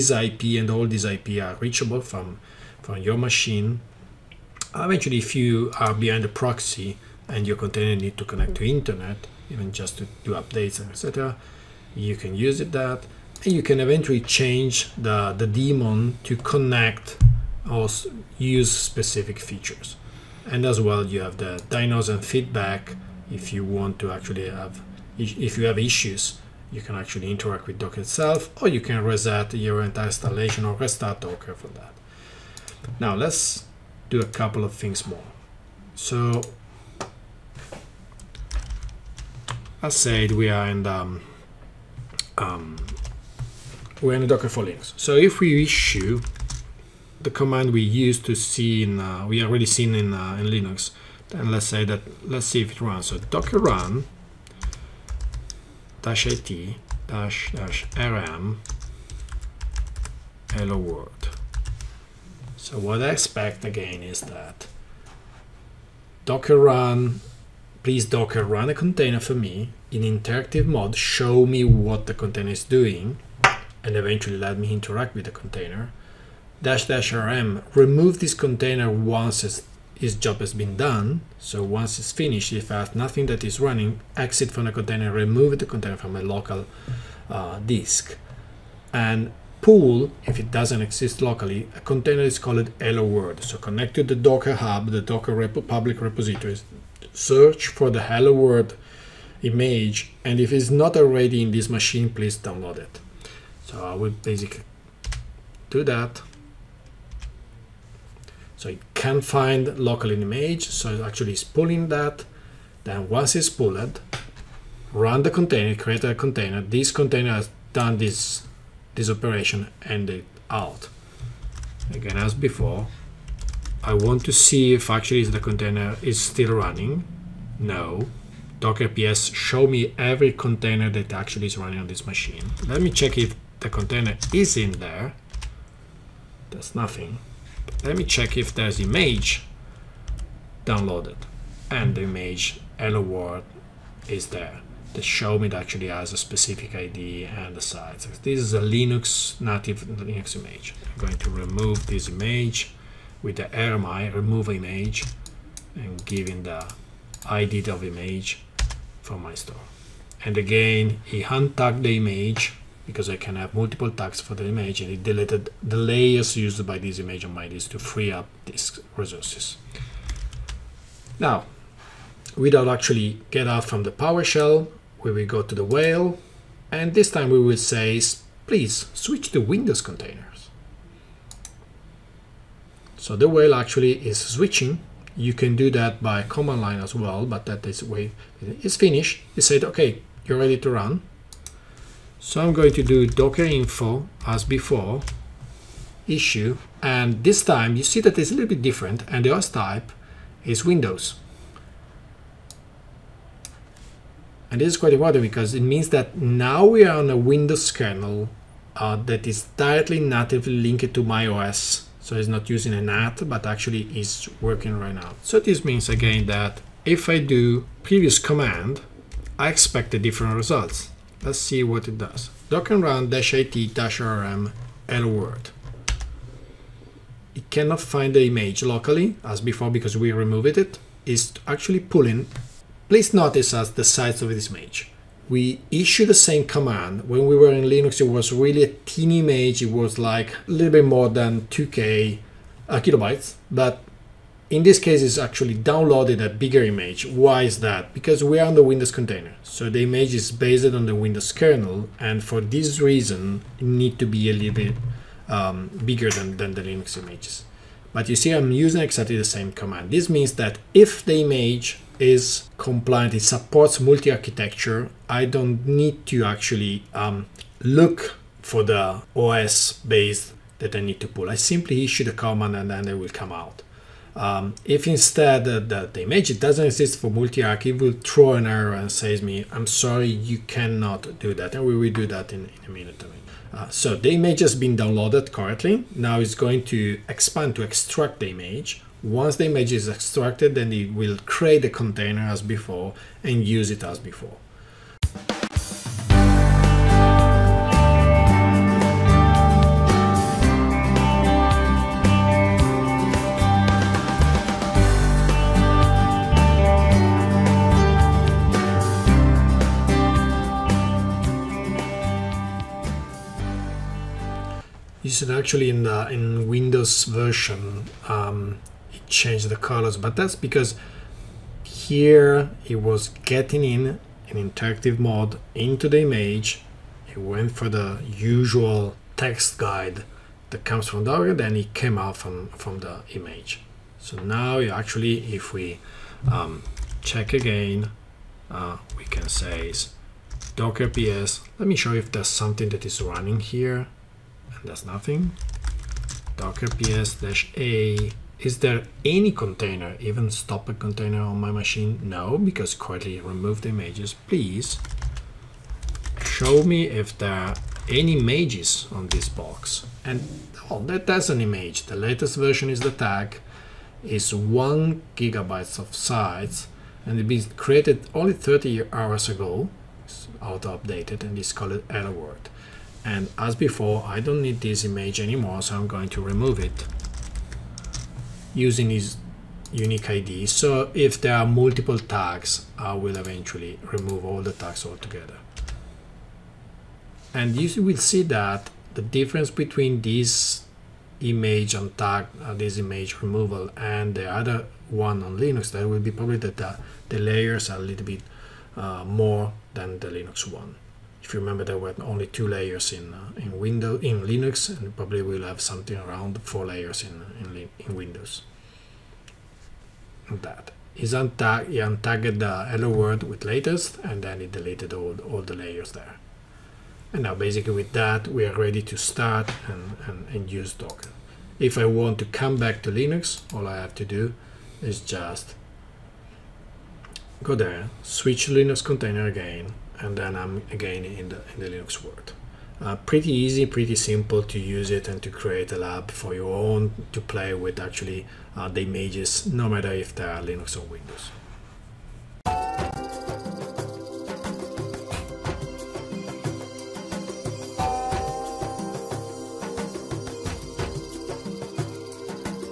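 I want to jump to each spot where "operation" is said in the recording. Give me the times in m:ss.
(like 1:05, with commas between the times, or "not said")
1:59.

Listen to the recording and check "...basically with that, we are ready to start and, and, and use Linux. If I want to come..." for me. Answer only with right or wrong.
wrong.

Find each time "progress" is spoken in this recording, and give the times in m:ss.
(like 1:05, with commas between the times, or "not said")
not said.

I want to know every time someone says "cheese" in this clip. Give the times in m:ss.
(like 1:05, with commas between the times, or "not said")
not said.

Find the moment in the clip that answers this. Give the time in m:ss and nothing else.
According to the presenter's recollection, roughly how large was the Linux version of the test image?
4:01.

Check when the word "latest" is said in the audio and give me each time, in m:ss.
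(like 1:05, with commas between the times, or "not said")
6:01, 6:53.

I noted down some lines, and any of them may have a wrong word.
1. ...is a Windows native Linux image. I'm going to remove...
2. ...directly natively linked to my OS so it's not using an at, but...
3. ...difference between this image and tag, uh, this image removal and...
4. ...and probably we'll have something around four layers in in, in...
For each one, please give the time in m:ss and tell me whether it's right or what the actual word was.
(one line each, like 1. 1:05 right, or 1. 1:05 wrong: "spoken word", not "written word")
1. 2:28 wrong: "Linux", not "Windows"
2. 3:29 right
3. 6:29 right
4. 6:44 right.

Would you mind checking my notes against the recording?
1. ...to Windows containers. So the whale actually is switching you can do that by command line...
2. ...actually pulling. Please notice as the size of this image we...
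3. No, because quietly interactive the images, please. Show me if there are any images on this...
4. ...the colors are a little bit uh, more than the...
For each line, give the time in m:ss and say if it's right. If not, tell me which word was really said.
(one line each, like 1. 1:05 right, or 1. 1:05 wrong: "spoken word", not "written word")
1. 2:59 right
2. 3:51 right
3. 5:52 wrong: "remove", not "interactive"
4. 6:37 wrong: "layers", not "colors".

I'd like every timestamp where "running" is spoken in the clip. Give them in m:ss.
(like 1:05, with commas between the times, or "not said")
1:23, 2:06, 2:11, 5:42.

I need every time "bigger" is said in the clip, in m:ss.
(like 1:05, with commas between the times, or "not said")
4:06, 4:15.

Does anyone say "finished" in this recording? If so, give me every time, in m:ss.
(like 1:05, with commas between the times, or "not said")
1:22, 3:08.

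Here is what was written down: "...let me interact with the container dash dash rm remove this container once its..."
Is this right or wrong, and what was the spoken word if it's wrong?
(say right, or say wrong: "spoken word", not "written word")
right.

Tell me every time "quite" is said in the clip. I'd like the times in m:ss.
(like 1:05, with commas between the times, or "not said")
3:24.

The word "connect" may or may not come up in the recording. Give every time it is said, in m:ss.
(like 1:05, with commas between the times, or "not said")
0:08, 0:16, 1:33.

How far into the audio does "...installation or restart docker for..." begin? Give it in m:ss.
0:30.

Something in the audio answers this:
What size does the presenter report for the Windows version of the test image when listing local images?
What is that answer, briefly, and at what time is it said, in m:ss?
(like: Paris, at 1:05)
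1 gigabyte, at 6:04.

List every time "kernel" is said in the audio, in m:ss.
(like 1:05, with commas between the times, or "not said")
3:27, 4:11.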